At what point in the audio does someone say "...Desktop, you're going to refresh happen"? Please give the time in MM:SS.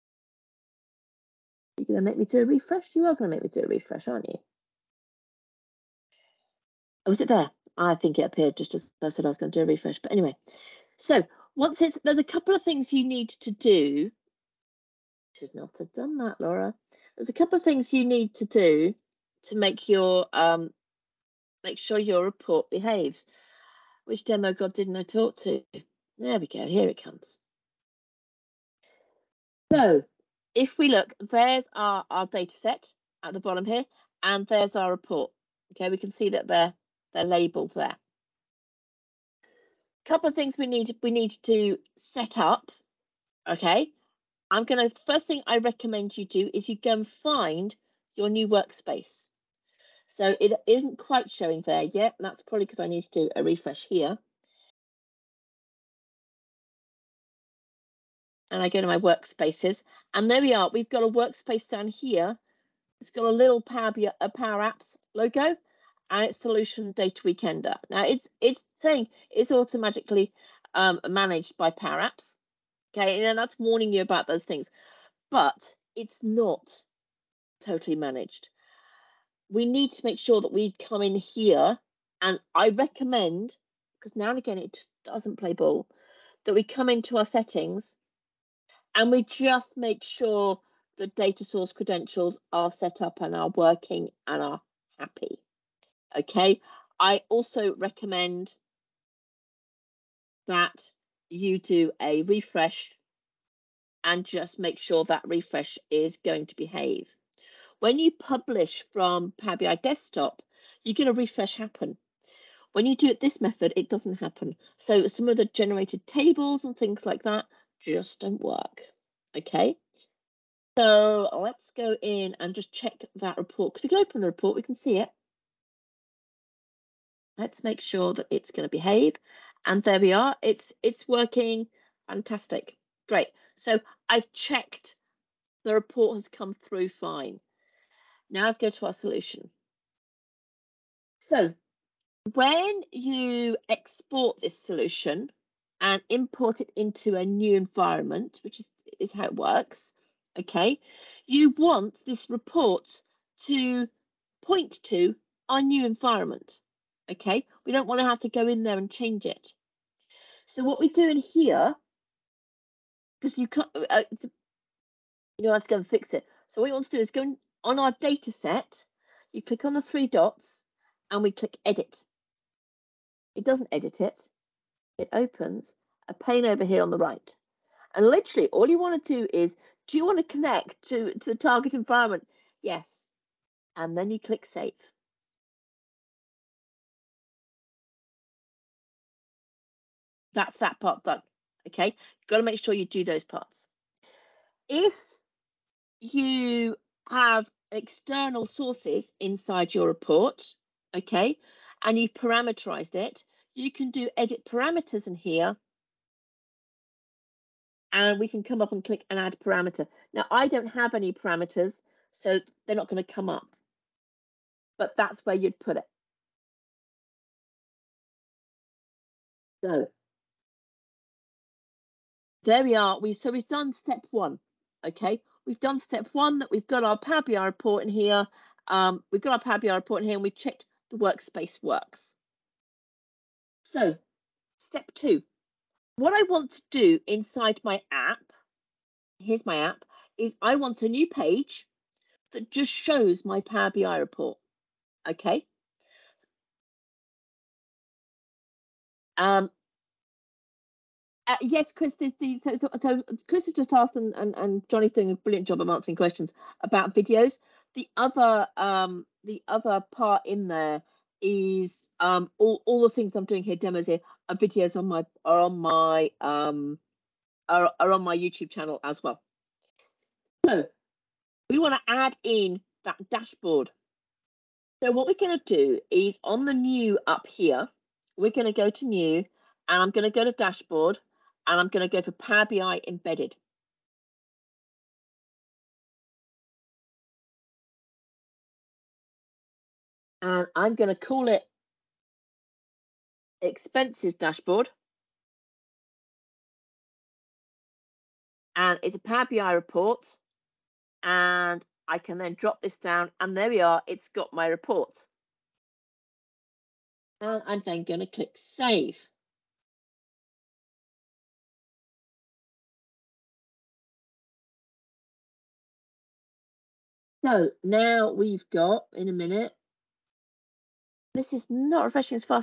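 01:49.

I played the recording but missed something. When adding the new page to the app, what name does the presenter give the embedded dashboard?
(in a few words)
expenses dashboard.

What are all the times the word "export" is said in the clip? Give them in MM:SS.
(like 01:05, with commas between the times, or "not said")
02:23.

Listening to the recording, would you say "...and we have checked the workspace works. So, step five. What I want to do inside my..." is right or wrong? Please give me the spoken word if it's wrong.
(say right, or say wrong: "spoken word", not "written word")
wrong: "two", not "five".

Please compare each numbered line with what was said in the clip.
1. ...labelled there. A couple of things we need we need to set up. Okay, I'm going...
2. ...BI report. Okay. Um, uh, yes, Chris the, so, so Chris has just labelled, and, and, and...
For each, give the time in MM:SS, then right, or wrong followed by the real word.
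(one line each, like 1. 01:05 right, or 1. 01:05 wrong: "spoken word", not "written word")
1. 00:37 right
2. 04:03 wrong: "asked", not "labelled".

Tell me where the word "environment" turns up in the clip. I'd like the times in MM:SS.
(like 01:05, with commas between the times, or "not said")
02:27, 02:35, 03:01.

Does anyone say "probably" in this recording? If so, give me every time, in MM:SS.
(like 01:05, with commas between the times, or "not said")
00:52.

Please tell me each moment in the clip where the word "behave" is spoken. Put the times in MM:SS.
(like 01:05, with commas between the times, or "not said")
00:22, 01:46, 02:08.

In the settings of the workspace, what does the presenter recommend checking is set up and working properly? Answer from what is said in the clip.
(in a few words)
data source credentials.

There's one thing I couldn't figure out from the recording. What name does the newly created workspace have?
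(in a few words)
solution data weekender.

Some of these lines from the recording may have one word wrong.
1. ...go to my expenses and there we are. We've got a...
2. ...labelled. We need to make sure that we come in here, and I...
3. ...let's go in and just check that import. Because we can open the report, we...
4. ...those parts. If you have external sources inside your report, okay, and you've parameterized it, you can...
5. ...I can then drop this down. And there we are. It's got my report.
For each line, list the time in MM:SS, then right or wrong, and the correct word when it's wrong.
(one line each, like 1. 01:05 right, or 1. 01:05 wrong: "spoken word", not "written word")
1. 00:58 wrong: "workspaces", not "expenses"
2. 01:17 wrong: "managed", not "labelled"
3. 02:01 wrong: "report", not "import"
4. 03:13 right
5. 05:01 right.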